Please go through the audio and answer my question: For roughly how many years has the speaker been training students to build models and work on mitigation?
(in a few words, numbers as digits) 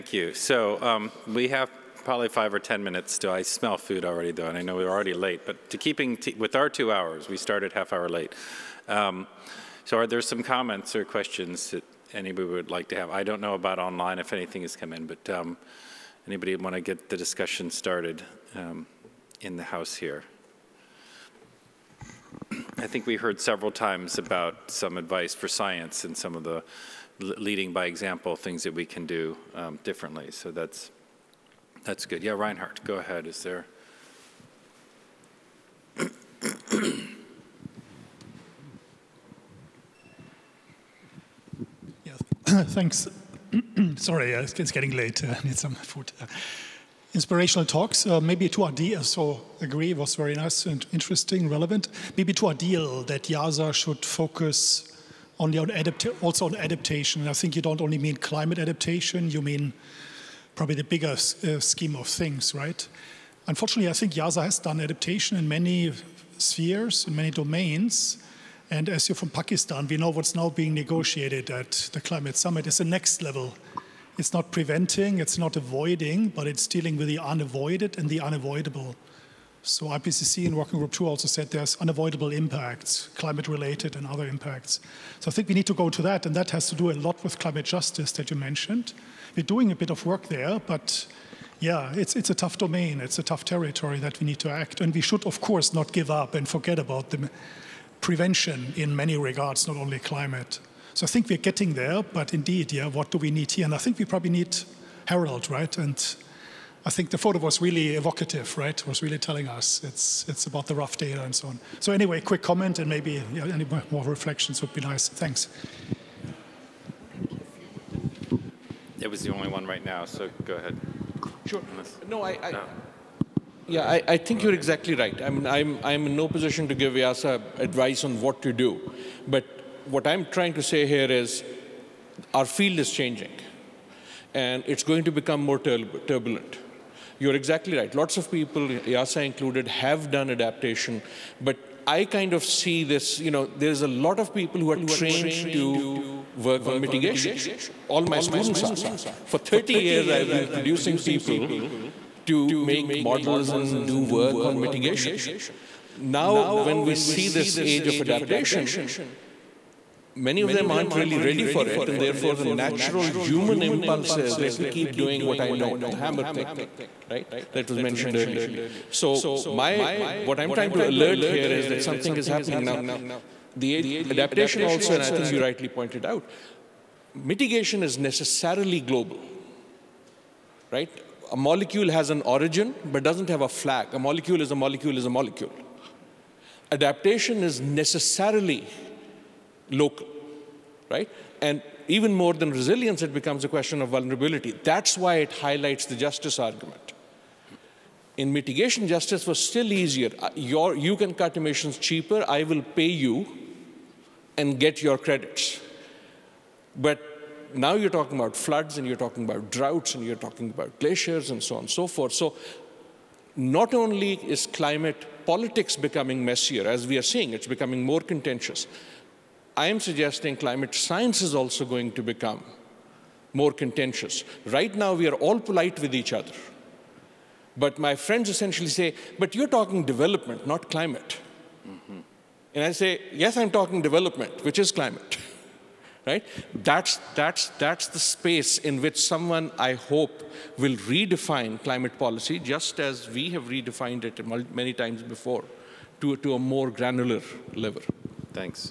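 30.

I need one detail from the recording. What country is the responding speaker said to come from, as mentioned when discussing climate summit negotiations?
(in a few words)
Pakistan.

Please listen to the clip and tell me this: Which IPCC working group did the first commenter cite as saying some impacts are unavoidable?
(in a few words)
Working Group 2.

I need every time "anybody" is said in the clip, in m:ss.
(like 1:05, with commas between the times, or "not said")
0:12, 0:16.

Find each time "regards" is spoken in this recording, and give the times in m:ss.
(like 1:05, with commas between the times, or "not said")
1:39.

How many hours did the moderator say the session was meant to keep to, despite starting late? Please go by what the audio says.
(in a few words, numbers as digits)
2.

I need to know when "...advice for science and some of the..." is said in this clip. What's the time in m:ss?
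0:24.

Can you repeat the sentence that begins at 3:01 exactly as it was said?
A molecule has an origin, but doesn't have a flag.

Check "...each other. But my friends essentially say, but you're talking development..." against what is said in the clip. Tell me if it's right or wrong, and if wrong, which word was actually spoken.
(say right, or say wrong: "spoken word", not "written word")
right.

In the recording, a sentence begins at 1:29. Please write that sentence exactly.
We're doing a bit of work there, but yeah, it's, it's a tough domain.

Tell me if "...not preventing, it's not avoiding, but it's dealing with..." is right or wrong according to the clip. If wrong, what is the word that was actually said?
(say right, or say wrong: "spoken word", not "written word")
right.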